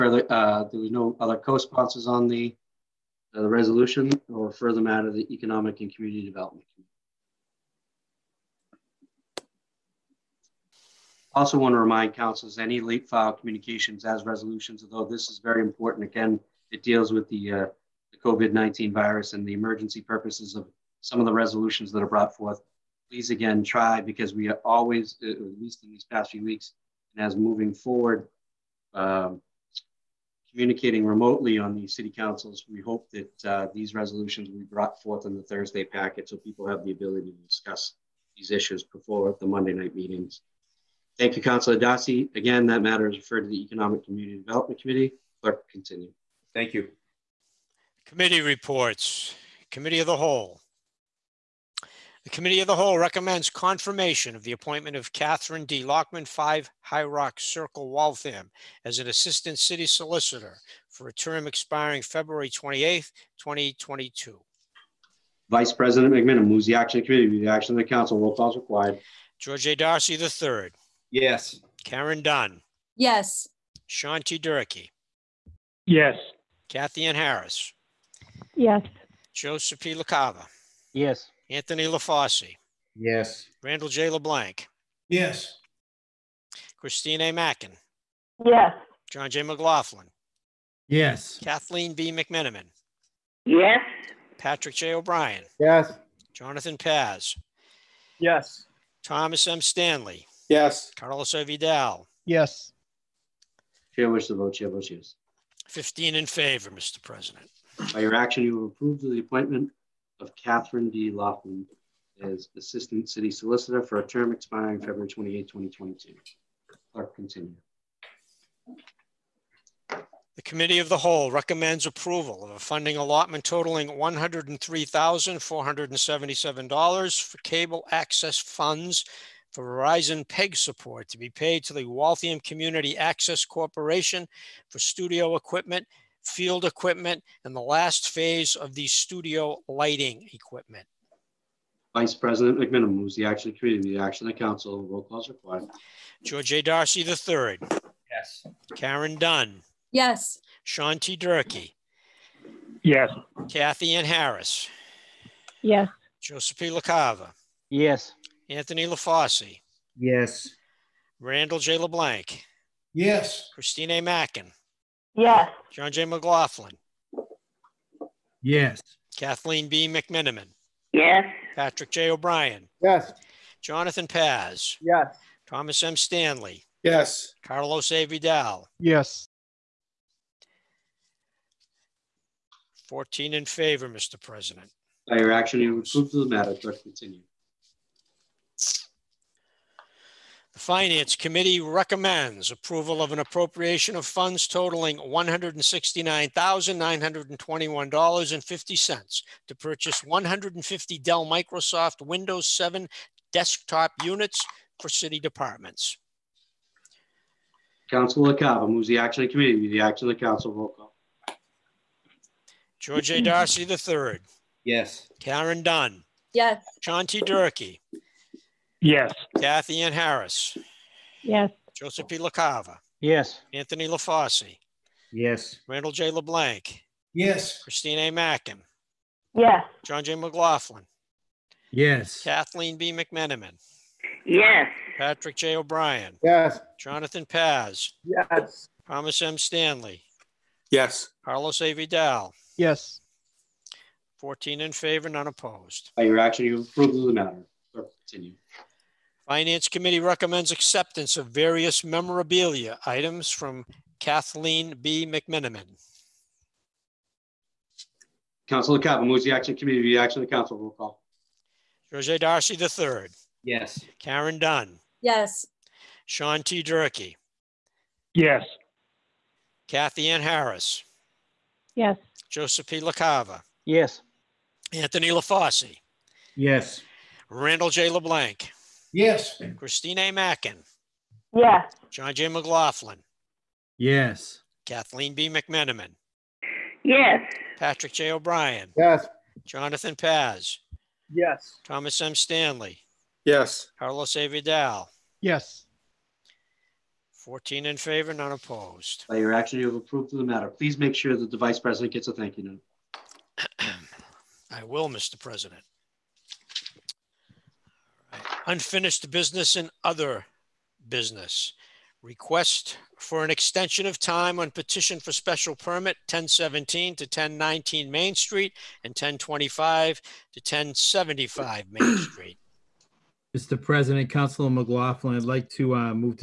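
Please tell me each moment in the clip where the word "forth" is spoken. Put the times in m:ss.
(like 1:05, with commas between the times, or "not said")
0:22, 0:35.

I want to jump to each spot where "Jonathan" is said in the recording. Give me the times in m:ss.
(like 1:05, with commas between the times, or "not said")
1:36, 2:53, 3:56, 4:49.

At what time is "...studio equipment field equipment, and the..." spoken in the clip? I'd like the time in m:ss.
2:14.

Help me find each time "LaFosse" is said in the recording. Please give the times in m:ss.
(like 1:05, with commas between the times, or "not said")
1:21, 2:38, 3:43, 4:35.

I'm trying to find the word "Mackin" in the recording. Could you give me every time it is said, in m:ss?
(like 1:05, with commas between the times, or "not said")
1:27, 2:44, 3:48, 4:40.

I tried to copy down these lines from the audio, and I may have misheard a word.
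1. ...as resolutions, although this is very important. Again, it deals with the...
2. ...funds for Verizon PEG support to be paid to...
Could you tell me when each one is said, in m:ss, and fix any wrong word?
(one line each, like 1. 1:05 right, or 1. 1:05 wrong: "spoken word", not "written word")
1. 0:14 right
2. 2:08 right.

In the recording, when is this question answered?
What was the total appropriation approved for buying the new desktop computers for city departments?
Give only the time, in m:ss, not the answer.
3:14.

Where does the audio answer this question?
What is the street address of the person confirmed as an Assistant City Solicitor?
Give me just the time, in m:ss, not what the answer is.
0:56.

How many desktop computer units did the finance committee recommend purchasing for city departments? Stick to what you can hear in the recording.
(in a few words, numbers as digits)
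150.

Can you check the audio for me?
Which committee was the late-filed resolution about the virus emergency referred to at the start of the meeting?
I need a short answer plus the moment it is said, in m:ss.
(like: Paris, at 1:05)
Economic and Community Development Committee, at 0:05.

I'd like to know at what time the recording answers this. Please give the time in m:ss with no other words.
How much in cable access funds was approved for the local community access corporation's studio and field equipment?
2:03.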